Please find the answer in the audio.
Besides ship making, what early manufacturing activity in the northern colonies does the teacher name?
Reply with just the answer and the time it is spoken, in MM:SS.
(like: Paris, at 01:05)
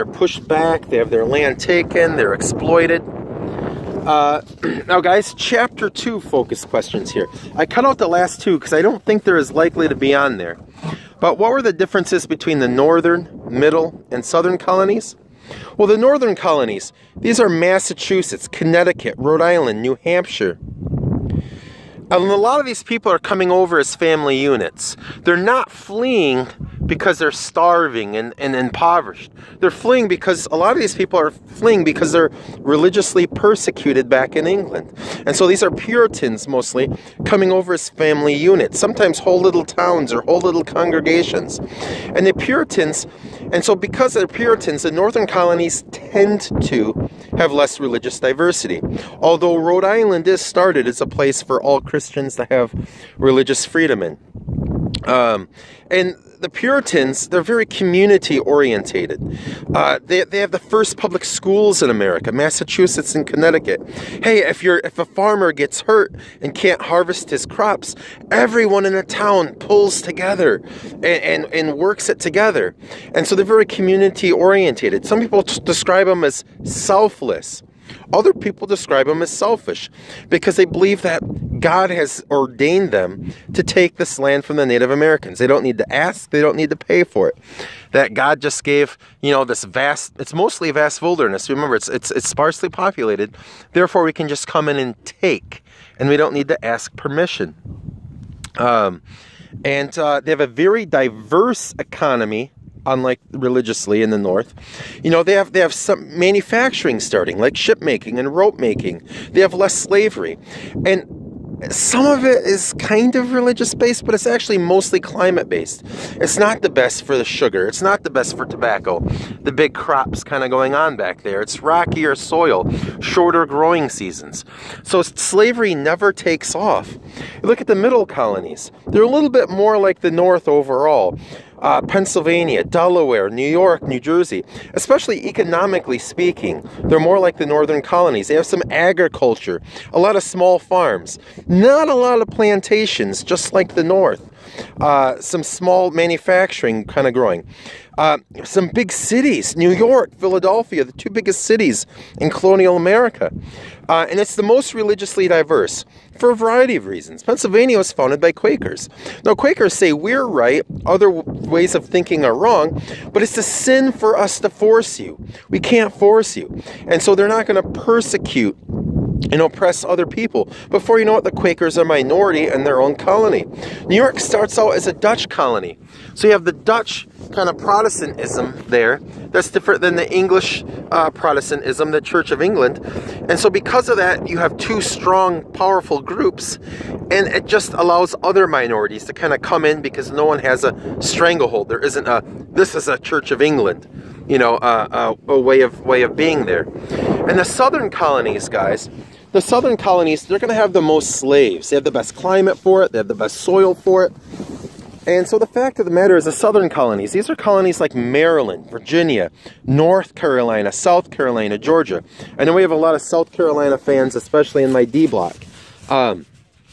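Rope making, at 01:48.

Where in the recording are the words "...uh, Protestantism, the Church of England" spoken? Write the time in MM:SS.
03:00.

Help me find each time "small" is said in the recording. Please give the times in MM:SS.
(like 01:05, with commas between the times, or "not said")
02:20, 02:25.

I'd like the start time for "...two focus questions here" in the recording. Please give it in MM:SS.
00:05.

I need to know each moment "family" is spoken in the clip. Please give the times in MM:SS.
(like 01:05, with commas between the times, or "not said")
00:23, 00:37.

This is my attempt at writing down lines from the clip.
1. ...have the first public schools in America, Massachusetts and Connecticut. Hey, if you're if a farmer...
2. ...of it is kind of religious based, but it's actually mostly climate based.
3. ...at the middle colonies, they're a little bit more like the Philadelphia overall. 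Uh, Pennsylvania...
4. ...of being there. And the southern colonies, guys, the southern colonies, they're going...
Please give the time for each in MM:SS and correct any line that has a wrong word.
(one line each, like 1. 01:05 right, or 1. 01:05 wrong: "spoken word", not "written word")
1. 01:00 right
2. 01:52 right
3. 02:07 wrong: "North", not "Philadelphia"
4. 03:16 right.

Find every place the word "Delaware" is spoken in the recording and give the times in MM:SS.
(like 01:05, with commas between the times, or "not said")
02:12.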